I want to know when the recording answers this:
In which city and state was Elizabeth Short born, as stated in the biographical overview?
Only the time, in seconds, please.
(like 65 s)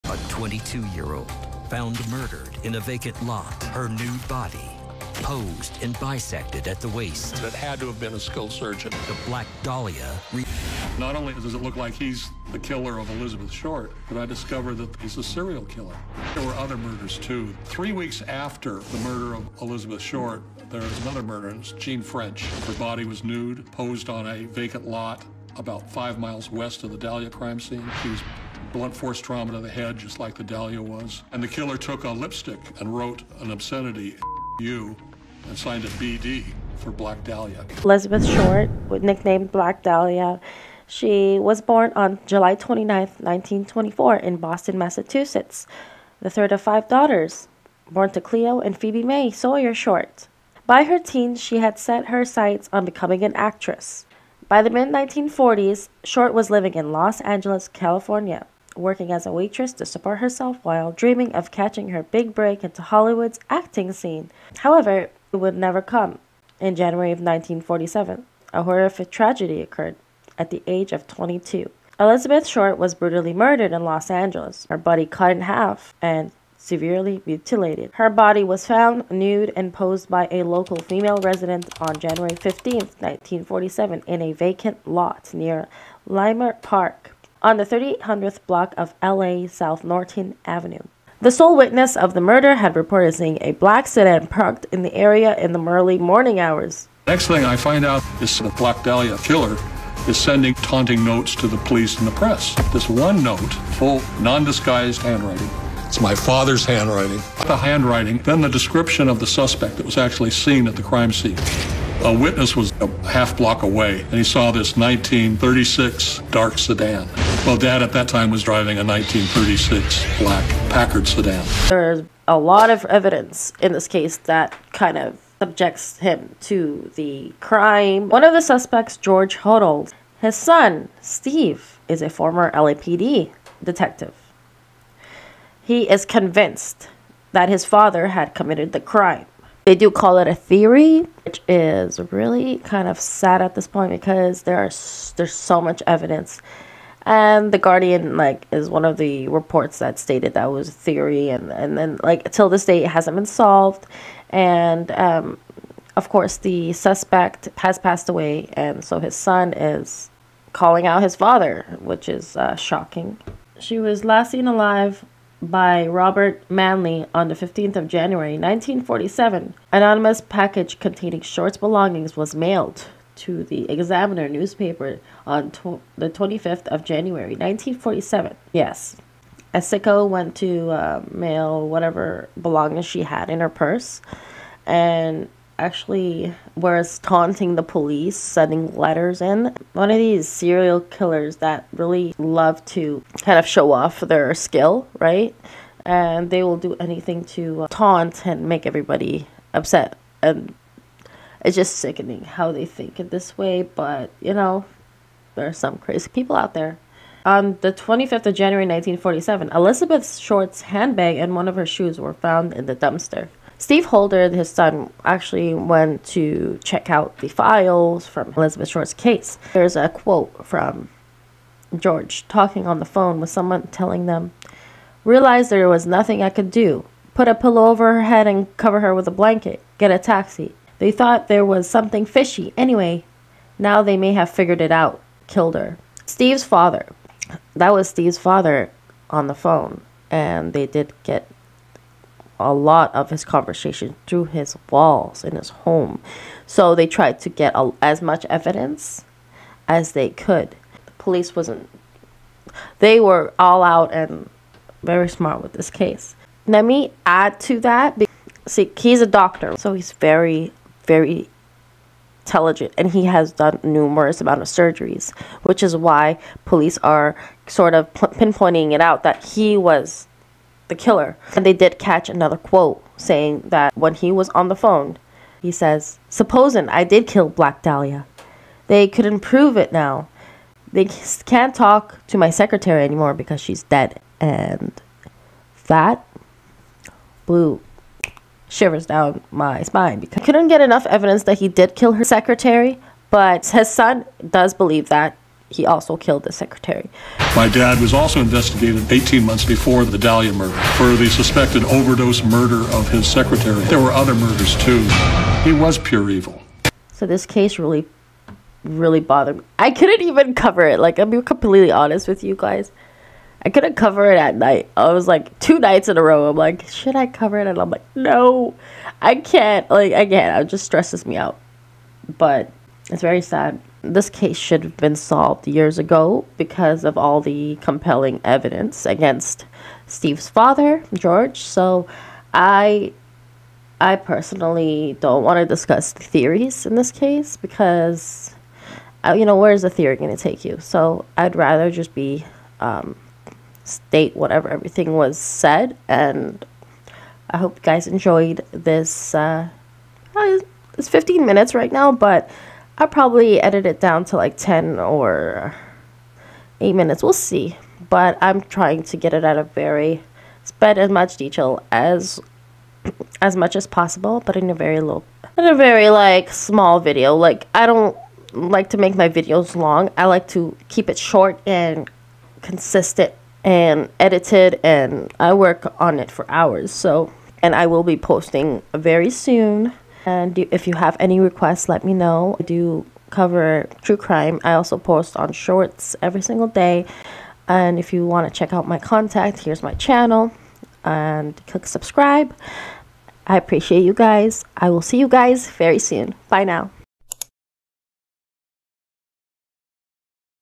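44 s.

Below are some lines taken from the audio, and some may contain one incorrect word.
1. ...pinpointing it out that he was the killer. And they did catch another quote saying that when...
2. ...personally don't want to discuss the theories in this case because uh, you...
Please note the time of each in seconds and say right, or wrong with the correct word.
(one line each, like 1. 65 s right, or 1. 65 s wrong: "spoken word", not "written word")
1. 267 s right
2. 333 s right.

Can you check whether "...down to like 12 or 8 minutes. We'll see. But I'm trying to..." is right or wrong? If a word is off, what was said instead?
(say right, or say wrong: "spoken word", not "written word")
wrong: "10", not "12".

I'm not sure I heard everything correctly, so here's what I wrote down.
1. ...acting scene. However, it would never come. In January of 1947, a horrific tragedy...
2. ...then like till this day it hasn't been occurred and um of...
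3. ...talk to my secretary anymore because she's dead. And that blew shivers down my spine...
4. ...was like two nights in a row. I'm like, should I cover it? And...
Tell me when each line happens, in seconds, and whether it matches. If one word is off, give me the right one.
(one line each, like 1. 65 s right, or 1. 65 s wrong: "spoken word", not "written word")
1. 63 s right
2. 151 s wrong: "solved", not "occurred"
3. 281 s right
4. 314 s right.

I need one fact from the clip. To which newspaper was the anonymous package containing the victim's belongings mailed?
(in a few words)
The Examiner.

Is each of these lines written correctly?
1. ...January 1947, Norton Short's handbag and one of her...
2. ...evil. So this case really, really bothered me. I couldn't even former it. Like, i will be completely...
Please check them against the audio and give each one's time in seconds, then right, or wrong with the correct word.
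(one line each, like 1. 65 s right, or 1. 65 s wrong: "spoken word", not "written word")
1. 208 s wrong: "Elizabeth", not "Norton"
2. 306 s wrong: "cover", not "former".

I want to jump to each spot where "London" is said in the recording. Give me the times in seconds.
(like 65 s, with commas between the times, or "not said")
not said.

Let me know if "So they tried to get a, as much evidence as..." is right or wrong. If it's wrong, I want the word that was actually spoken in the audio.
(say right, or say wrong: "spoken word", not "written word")
right.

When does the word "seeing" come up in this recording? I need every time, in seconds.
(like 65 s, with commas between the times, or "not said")
93 s.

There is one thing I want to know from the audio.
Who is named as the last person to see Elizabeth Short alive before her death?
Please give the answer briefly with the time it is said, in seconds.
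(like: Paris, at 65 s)
Robert Manley, at 165 s.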